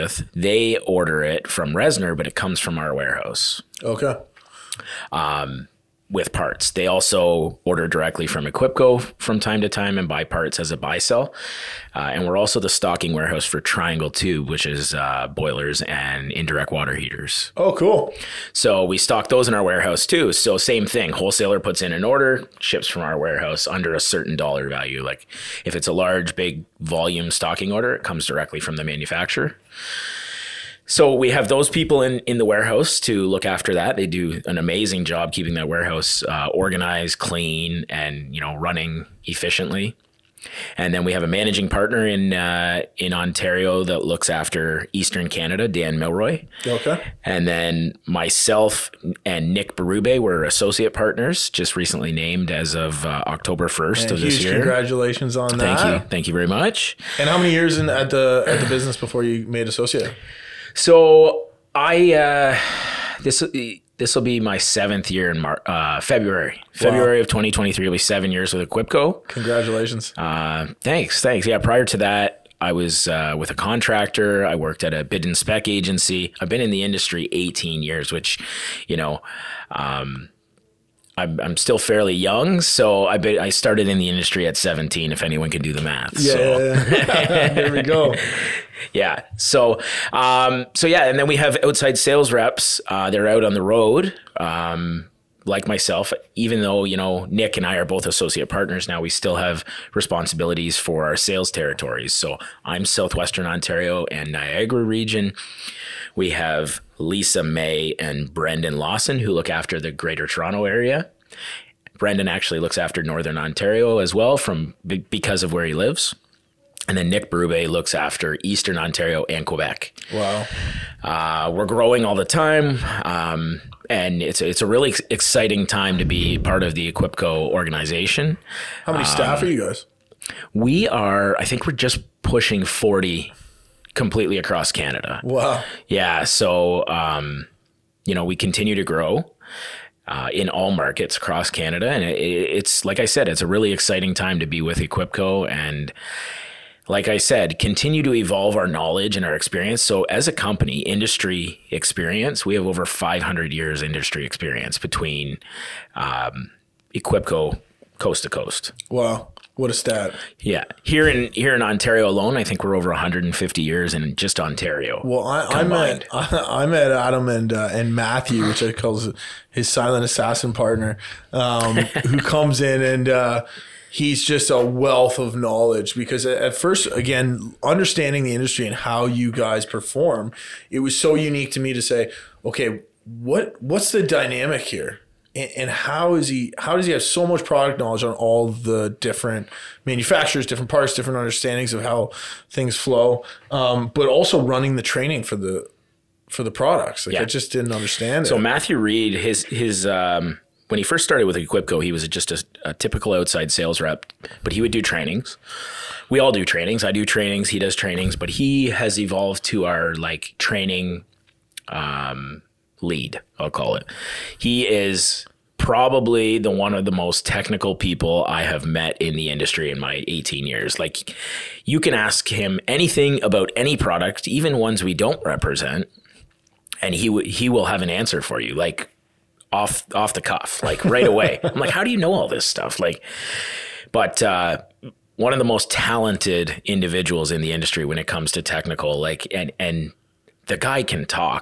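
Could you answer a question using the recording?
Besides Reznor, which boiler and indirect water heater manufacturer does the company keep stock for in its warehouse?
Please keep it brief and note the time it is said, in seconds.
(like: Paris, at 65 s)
Triangle Tube, at 13 s.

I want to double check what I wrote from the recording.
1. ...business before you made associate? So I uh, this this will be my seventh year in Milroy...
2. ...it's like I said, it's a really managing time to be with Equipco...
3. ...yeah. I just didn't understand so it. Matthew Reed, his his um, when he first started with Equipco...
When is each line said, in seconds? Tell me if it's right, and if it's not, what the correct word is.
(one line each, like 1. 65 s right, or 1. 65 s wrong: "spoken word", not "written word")
1. 58 s wrong: "Mar", not "Milroy"
2. 142 s wrong: "exciting", not "managing"
3. 197 s right.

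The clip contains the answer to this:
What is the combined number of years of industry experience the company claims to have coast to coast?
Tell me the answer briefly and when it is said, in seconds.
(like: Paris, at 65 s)
500, at 152 s.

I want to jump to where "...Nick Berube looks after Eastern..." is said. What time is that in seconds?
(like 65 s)
117 s.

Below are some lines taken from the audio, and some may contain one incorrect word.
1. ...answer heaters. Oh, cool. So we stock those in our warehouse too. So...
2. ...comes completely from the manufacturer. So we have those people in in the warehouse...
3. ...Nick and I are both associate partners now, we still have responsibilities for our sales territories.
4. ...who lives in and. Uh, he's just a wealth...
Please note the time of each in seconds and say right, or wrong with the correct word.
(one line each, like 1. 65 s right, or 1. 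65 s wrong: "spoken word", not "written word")
1. 16 s wrong: "water", not "answer"
2. 28 s wrong: "directly", not "completely"
3. 97 s right
4. 172 s wrong: "comes", not "lives".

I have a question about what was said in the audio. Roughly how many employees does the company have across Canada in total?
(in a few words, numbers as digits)
40.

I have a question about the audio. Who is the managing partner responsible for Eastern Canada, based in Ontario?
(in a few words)
Dan Milroy.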